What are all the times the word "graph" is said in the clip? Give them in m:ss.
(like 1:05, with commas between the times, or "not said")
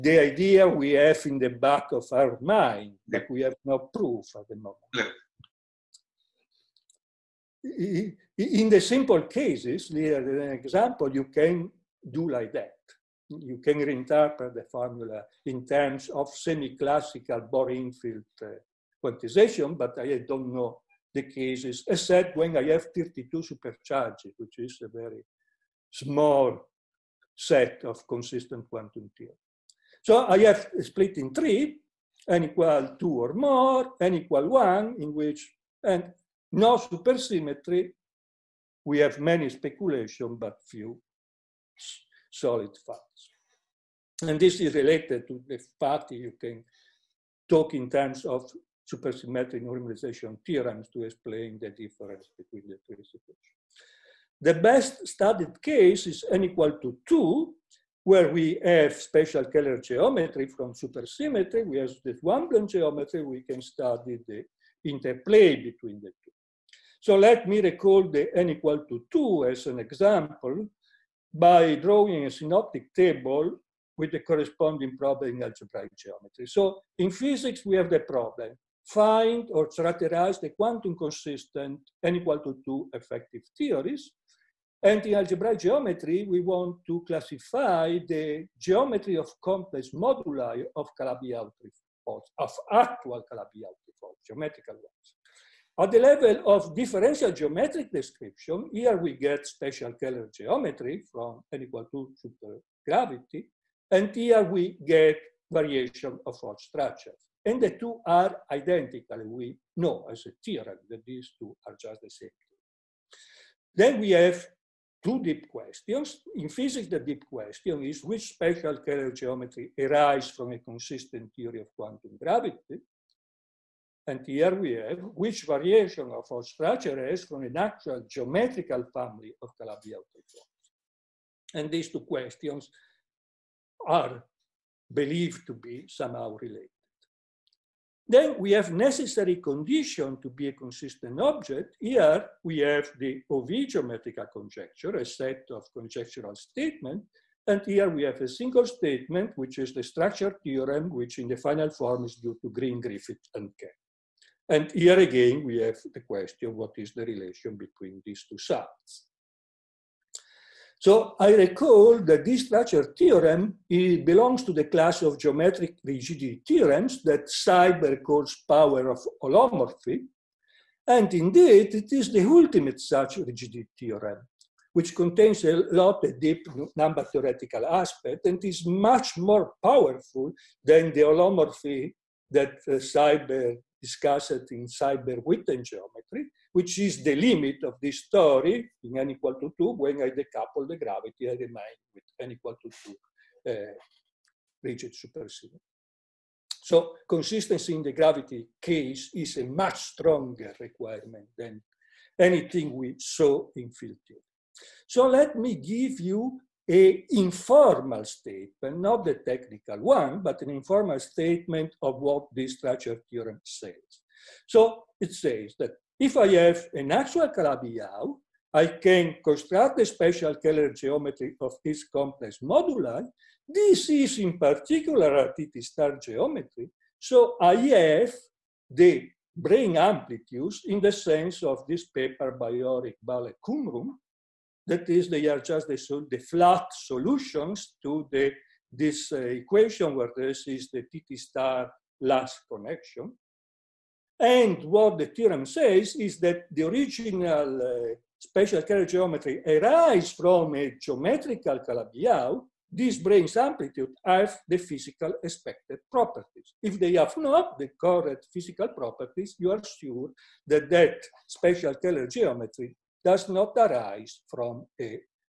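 not said.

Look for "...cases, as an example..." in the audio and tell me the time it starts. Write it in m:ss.
0:09.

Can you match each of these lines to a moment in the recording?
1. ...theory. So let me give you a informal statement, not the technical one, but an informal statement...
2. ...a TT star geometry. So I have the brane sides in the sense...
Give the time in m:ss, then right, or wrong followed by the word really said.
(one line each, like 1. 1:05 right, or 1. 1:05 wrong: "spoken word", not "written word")
1. 3:24 right
2. 3:45 wrong: "amplitudes", not "sides".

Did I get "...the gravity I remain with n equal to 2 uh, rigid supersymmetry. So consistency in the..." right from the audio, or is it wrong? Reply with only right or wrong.
right.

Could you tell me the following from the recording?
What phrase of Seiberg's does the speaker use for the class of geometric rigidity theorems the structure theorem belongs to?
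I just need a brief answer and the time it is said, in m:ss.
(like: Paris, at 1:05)
power of holomorphy, at 2:48.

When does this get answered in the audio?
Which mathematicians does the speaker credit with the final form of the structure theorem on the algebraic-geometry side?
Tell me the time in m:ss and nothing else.
2:32.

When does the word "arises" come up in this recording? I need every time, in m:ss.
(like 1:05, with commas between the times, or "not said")
1:59, 2:06, 4:09, 4:23.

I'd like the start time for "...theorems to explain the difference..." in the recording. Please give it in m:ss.
0:50.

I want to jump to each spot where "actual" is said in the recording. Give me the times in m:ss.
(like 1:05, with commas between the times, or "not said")
1:32, 2:07, 3:36.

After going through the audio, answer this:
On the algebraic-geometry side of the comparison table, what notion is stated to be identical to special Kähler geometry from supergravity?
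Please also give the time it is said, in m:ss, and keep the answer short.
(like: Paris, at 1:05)
variation of Hodge structures, at 1:45.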